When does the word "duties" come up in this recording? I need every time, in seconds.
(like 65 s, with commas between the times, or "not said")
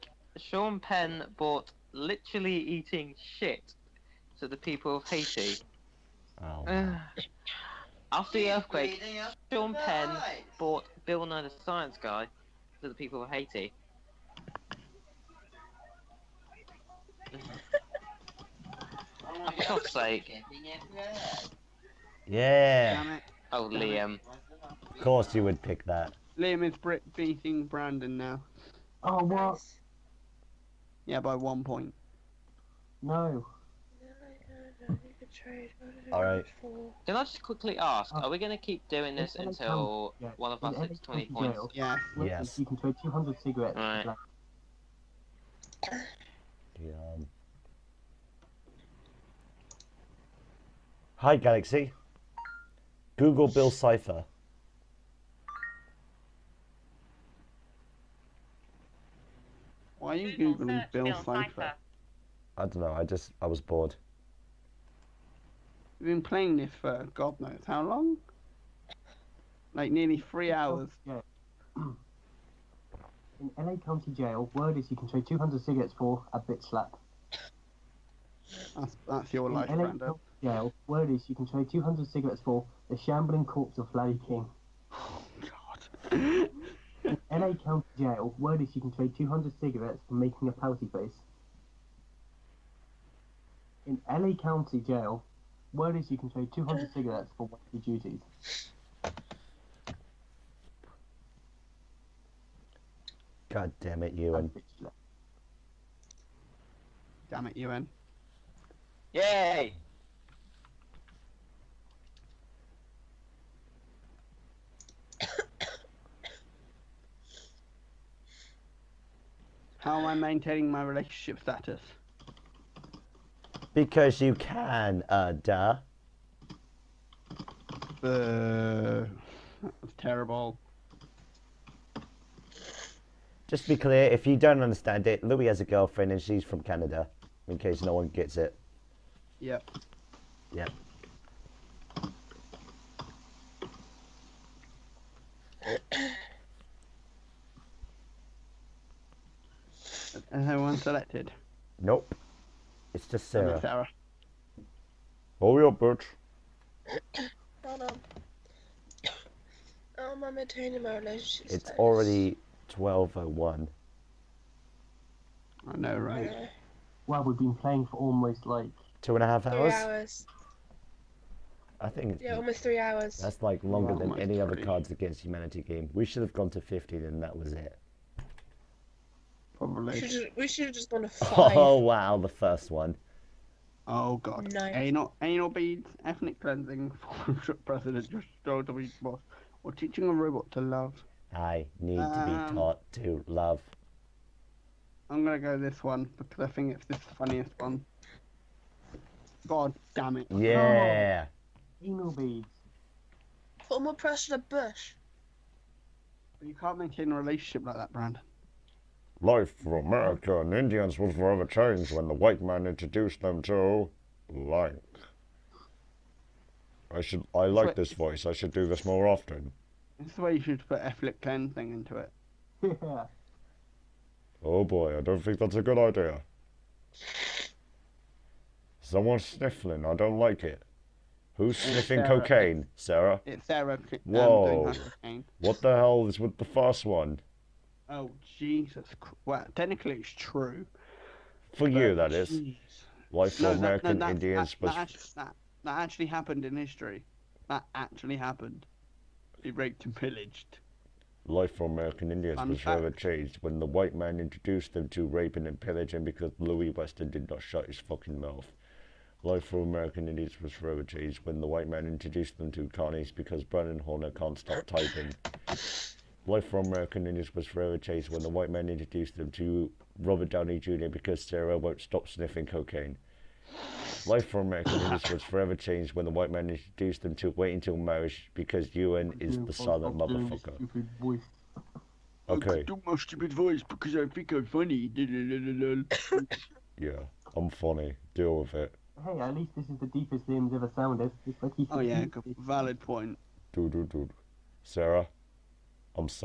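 97 s.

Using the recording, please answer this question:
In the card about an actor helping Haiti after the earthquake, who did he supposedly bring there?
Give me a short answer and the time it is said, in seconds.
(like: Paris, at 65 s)
Bill Nye the Science Guy, at 11 s.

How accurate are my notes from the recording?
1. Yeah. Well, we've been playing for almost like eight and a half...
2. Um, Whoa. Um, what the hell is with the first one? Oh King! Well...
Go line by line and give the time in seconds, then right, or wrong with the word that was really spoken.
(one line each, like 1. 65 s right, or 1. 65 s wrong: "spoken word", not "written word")
1. 166 s wrong: "two", not "eight"
2. 233 s wrong: "Jesus", not "King".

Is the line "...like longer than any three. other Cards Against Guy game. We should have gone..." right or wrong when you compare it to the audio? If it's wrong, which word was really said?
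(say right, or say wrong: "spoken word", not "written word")
wrong: "Humanity", not "Guy".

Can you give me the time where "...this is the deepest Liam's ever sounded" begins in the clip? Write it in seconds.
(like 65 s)
289 s.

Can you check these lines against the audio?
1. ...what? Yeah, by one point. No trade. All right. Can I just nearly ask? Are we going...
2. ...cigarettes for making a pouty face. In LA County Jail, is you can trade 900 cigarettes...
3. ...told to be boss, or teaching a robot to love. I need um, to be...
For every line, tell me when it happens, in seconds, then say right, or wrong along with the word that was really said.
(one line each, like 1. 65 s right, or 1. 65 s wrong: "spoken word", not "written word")
1. 29 s wrong: "quickly", not "nearly"
2. 89 s wrong: "200", not "900"
3. 188 s right.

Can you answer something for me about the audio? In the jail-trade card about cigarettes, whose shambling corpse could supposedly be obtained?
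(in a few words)
Larry King.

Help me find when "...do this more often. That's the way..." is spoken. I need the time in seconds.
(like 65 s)
218 s.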